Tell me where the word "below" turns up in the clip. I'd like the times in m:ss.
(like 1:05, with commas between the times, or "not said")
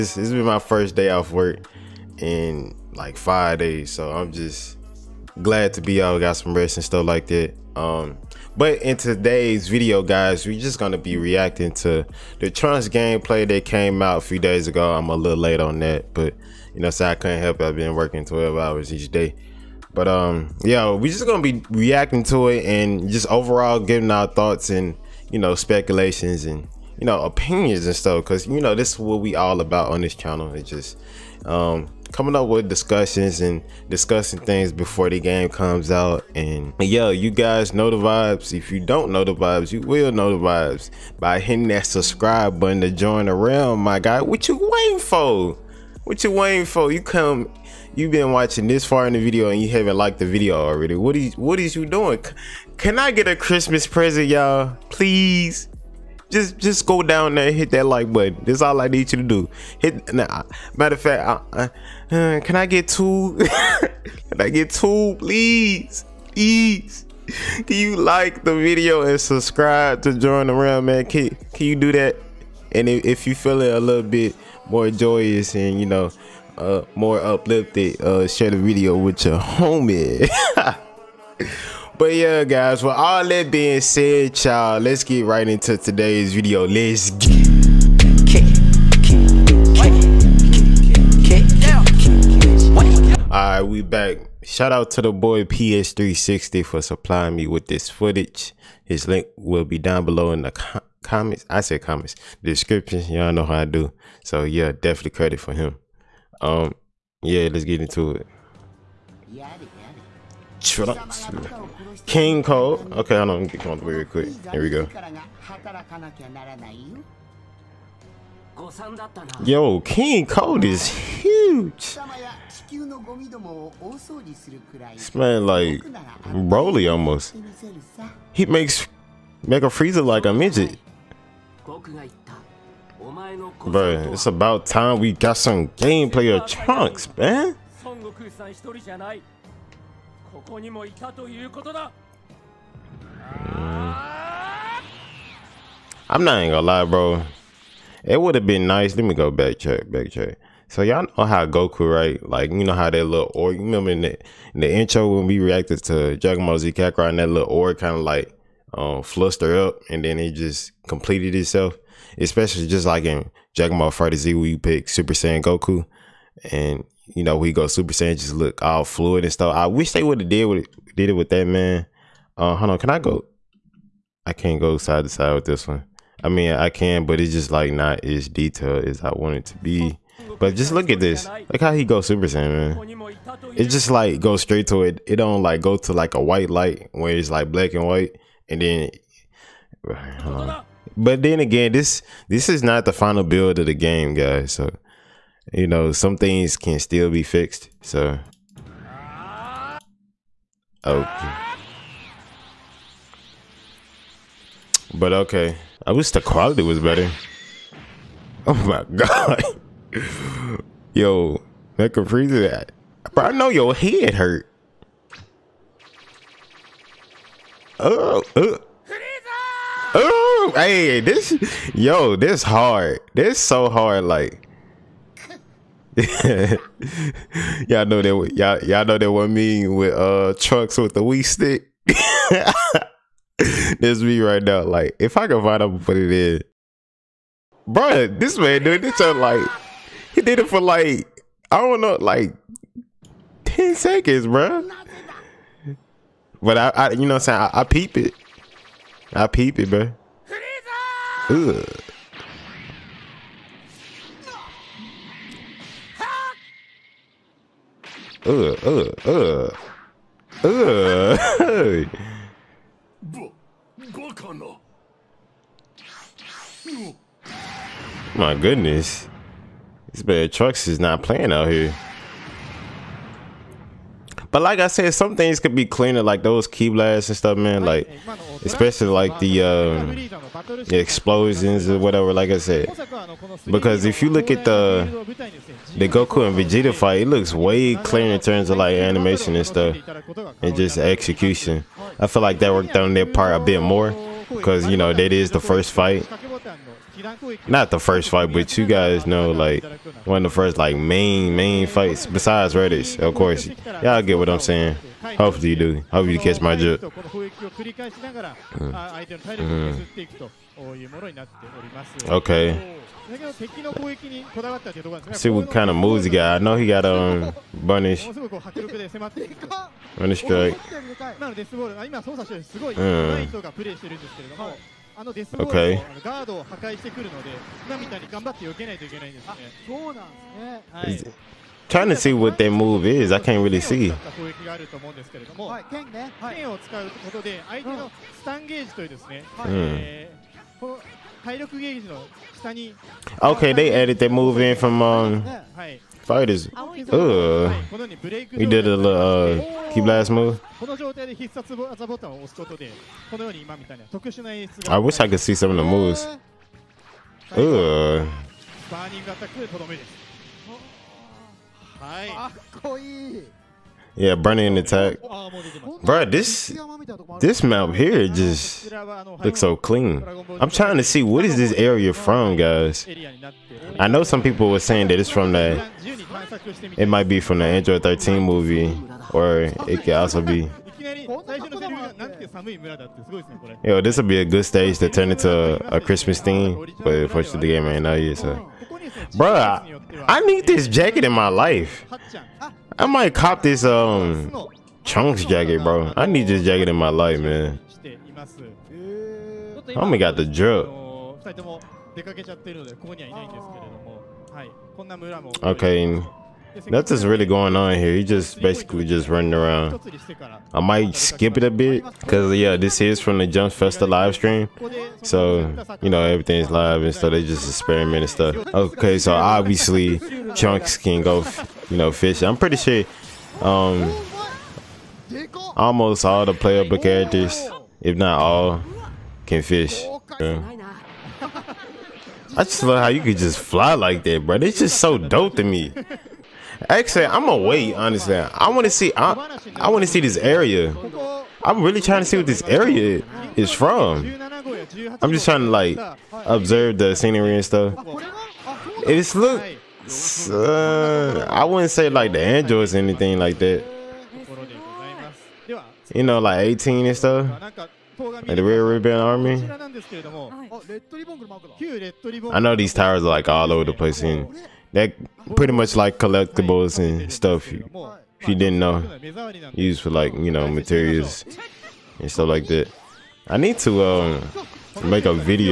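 1:40.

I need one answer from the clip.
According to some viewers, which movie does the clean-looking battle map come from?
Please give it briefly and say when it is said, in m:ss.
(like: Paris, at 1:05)
Android 13 movie, at 6:17.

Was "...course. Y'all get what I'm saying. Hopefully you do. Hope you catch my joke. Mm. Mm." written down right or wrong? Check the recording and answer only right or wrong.
right.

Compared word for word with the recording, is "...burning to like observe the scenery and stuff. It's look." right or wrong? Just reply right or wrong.
wrong.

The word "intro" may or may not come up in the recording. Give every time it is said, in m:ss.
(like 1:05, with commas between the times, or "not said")
2:34.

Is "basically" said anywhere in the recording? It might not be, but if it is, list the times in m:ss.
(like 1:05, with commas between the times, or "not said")
6:48.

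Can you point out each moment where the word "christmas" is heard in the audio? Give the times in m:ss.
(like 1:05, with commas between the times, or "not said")
0:53, 6:25.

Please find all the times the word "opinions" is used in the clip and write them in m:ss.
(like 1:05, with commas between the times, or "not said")
0:27.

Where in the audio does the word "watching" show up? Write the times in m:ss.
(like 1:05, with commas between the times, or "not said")
0:48.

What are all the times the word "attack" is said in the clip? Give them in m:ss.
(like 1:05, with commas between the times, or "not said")
6:04.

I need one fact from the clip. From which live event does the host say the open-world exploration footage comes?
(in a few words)
Jump Festa.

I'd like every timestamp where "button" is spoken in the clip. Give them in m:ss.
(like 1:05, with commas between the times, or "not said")
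0:42, 0:58.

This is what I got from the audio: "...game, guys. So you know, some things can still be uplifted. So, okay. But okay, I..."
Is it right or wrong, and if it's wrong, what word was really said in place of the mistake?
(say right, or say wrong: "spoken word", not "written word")
wrong: "fixed", not "uplifted".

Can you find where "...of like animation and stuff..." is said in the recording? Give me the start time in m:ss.
4:48.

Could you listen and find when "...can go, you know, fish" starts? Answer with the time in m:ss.
7:00.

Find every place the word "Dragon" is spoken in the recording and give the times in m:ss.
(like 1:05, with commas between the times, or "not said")
2:36, 2:43.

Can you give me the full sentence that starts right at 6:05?
Bro, this this map here just looks so clean.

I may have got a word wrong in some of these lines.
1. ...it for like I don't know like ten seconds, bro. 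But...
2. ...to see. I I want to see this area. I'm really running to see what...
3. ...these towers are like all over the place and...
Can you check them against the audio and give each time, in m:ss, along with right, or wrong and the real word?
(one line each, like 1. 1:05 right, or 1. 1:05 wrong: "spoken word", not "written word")
1. 4:00 right
2. 7:18 wrong: "trying", not "running"
3. 7:42 right.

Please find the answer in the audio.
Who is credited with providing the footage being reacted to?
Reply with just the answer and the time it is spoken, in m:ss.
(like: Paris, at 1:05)
PS360, at 1:35.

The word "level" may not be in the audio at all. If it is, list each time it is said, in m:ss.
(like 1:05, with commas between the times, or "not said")
not said.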